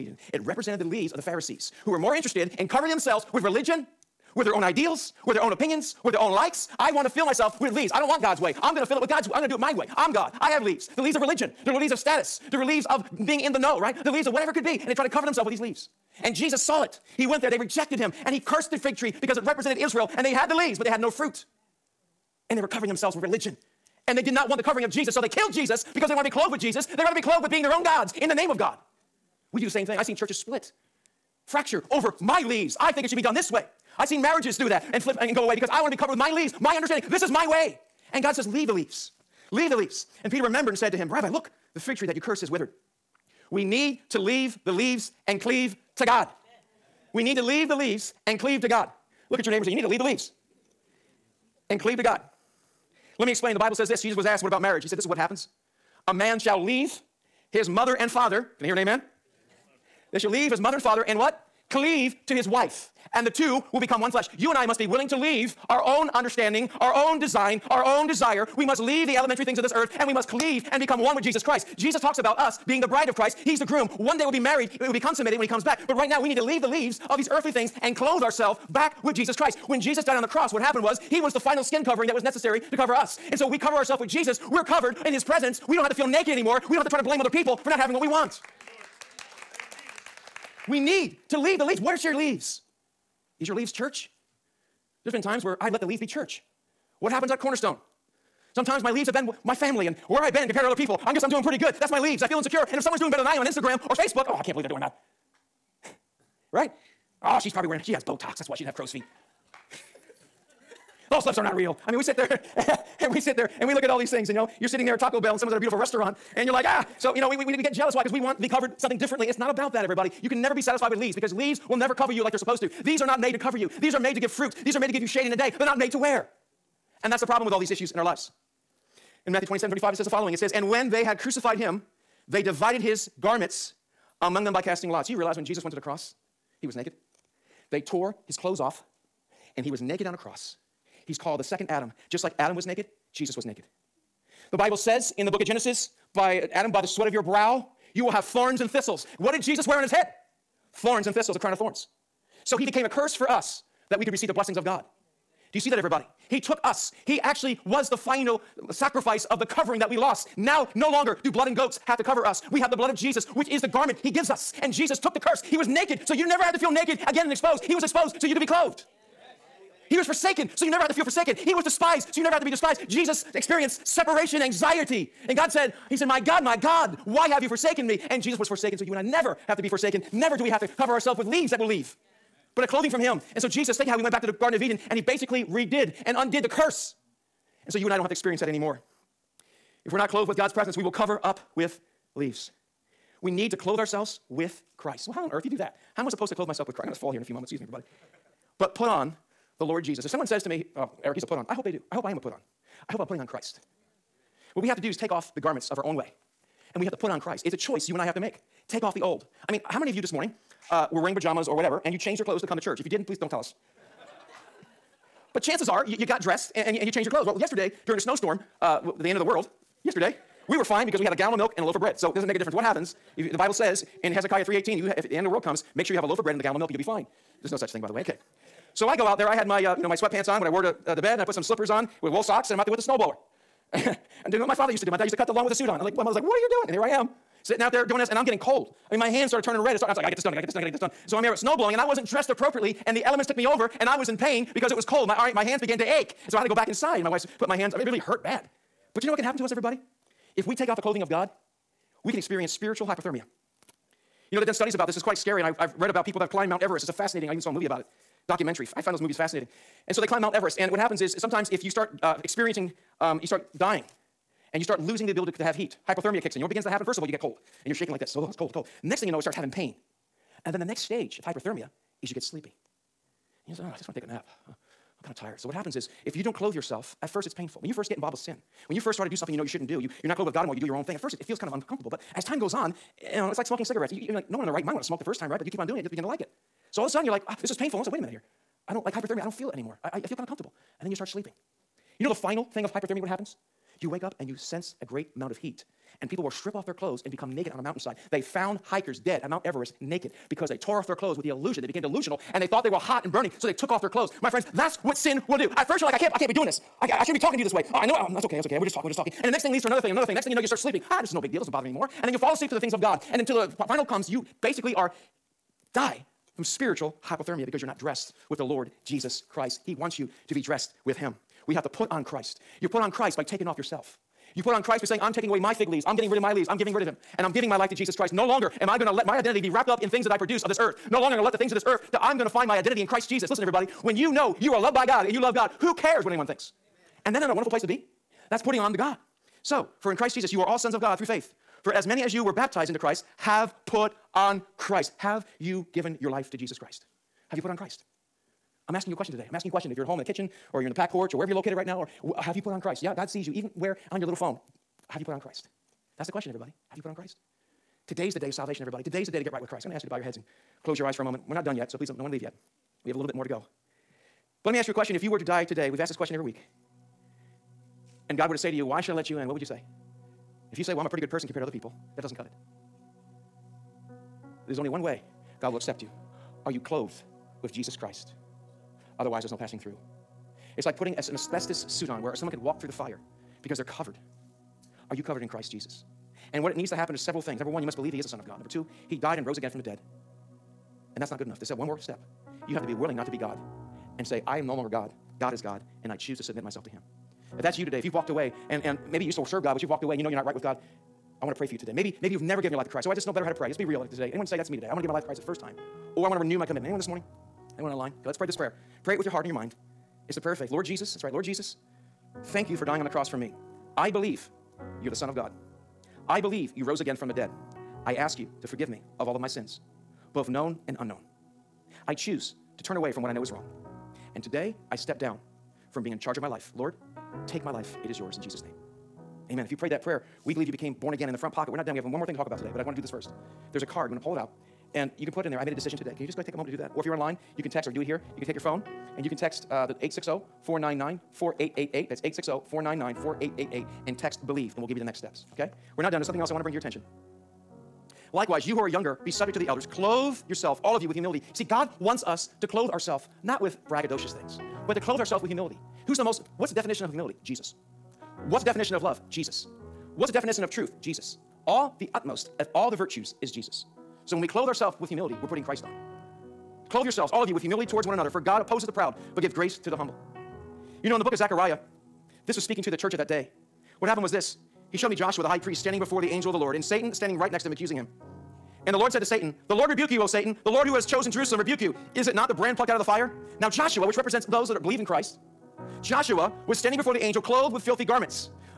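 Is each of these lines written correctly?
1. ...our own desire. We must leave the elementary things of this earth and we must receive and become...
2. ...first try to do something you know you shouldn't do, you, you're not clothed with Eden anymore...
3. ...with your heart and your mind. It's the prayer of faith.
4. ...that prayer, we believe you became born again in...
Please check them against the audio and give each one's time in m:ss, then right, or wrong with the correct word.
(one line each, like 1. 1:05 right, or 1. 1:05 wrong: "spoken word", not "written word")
1. 1:07 wrong: "cleave", not "receive"
2. 4:38 wrong: "God", not "Eden"
3. 6:48 right
4. 7:09 right.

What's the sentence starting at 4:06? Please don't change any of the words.
And my wife put my hands, I mean, it really hurt bad.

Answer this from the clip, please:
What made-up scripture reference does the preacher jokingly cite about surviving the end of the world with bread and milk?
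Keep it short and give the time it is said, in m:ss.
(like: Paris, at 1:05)
Hezekiah 3:18, at 3:44.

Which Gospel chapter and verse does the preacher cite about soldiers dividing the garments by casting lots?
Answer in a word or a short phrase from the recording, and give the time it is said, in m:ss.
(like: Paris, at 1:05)
Matthew 27:35, at 2:09.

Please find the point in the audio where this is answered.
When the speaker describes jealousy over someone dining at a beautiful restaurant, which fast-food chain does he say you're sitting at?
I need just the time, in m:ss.
1:54.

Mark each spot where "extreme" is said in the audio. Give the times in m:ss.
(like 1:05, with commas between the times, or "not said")
not said.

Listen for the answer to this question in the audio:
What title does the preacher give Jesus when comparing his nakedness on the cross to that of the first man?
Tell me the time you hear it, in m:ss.
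2:21.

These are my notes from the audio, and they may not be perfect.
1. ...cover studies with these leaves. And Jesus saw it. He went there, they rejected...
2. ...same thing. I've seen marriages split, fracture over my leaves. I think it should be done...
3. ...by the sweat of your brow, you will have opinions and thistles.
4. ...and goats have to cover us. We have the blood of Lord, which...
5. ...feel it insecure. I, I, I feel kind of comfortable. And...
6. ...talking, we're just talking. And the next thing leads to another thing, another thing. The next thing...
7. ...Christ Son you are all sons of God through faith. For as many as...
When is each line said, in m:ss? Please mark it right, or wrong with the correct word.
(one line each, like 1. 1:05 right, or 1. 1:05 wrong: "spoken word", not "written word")
1. 0:15 wrong: "themselves", not "studies"
2. 0:29 wrong: "churches", not "marriages"
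3. 2:26 wrong: "thorns", not "opinions"
4. 2:41 wrong: "Jesus", not "Lord"
5. 4:49 wrong: "anymore", not "insecure"
6. 5:08 right
7. 5:39 wrong: "Jesus", not "Son".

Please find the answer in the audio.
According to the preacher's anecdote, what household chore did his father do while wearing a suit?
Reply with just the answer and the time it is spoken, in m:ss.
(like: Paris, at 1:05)
Cut the lawn, at 3:55.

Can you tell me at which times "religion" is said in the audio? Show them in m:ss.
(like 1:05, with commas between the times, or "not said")
0:03, 0:11, 0:23.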